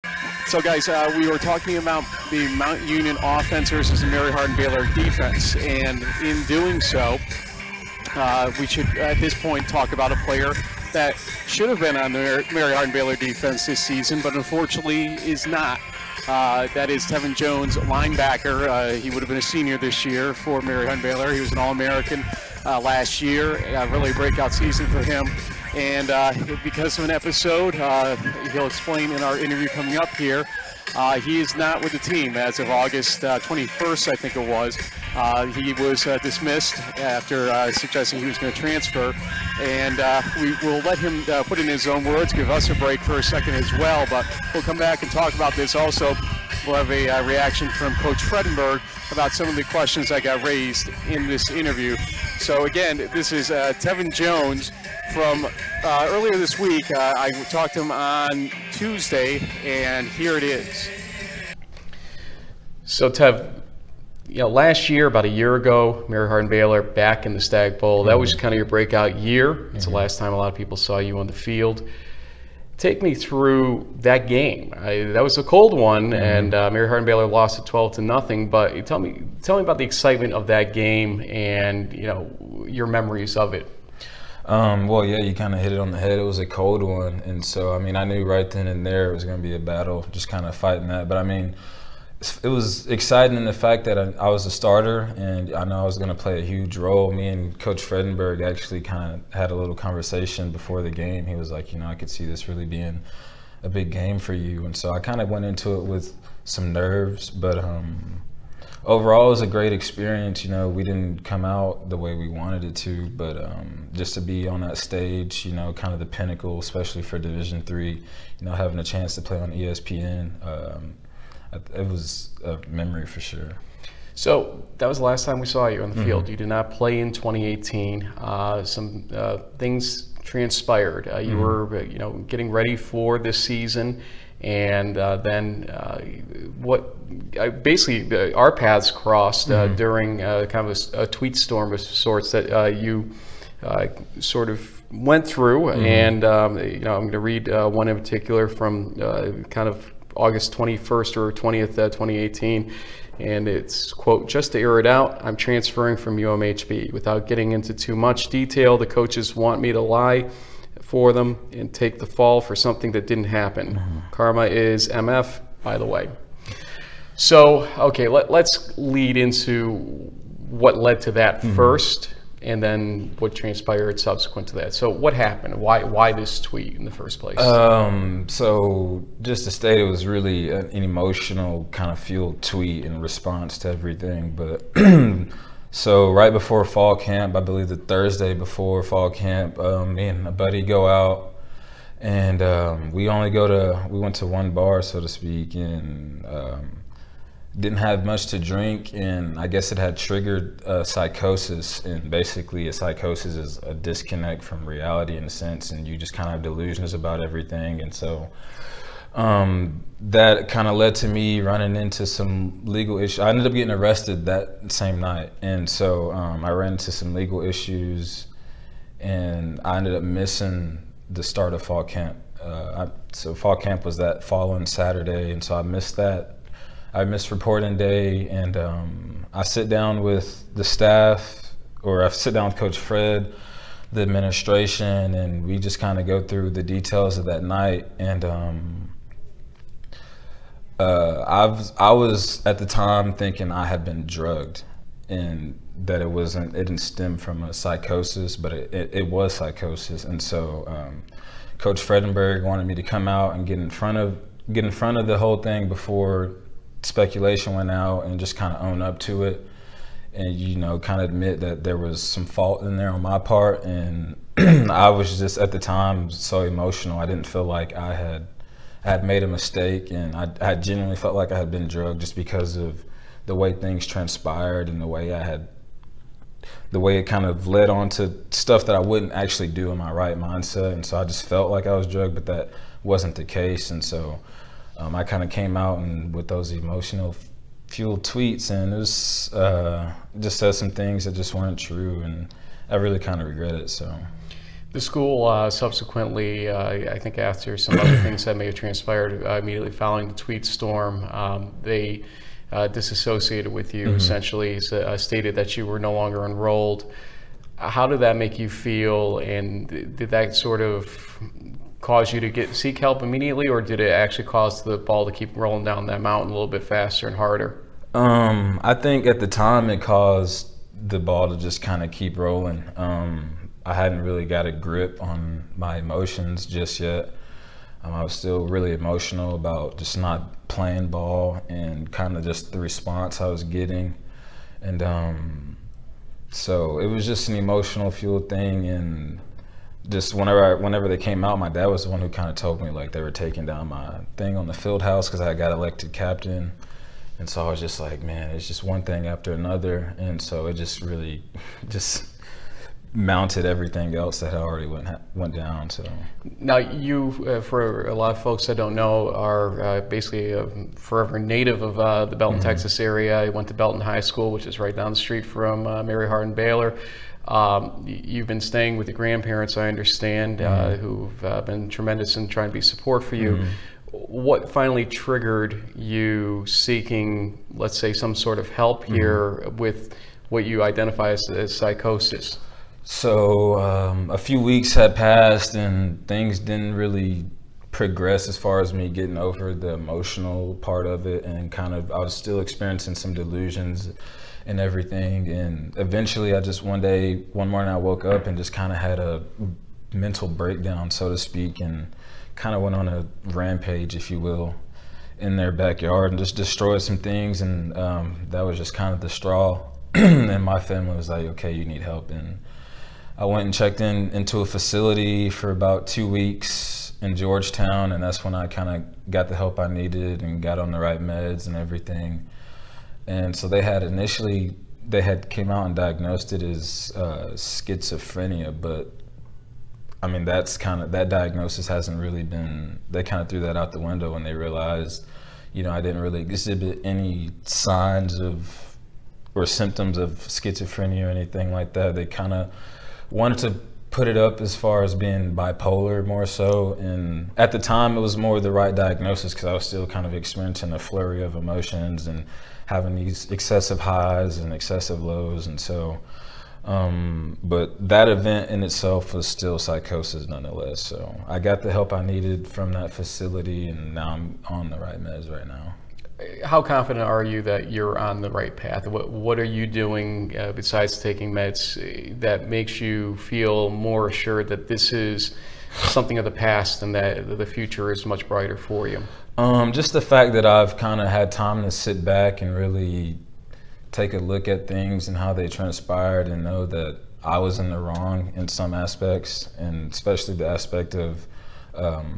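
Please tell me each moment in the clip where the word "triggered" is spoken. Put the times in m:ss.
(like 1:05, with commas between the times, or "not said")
3:19, 6:14.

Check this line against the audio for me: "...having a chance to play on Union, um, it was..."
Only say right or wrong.
wrong.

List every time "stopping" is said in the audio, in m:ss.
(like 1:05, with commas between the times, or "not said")
not said.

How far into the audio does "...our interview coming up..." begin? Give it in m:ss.
0:29.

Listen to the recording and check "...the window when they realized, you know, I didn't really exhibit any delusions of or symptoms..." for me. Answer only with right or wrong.
wrong.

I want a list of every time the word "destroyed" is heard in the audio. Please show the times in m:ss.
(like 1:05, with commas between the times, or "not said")
6:46.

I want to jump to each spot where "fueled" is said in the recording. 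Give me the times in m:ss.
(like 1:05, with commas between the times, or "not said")
3:01, 4:47, 5:37.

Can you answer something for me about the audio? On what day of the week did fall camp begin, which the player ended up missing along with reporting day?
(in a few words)
Saturday.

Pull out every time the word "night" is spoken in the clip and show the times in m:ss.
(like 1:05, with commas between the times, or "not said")
3:34, 3:57.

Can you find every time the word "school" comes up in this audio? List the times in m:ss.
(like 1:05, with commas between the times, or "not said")
4:54, 6:04.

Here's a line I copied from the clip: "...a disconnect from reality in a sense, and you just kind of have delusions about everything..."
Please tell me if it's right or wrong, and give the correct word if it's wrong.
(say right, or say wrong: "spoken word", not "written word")
right.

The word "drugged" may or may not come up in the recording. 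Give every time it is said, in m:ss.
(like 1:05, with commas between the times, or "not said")
4:04, 4:31, 4:41.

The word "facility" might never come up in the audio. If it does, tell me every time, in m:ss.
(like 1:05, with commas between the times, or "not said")
6:54, 7:42.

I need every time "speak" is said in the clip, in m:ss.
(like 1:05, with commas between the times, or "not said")
3:15, 6:41.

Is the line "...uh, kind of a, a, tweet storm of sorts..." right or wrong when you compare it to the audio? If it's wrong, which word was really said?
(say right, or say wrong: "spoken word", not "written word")
right.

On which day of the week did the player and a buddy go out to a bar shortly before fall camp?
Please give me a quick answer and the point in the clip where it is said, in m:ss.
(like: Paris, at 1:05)
Thursday, at 3:07.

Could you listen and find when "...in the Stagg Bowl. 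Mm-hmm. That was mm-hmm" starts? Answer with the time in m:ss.
1:07.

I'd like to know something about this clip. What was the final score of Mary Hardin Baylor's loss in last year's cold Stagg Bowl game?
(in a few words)
12-0.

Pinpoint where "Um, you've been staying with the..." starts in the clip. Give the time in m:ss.
6:07.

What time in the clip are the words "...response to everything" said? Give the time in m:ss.
3:02.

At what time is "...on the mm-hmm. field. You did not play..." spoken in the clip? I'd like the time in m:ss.
2:05.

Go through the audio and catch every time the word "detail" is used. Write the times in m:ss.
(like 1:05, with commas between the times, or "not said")
2:38, 3:56.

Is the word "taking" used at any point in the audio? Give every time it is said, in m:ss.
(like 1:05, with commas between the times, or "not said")
5:43, 7:50.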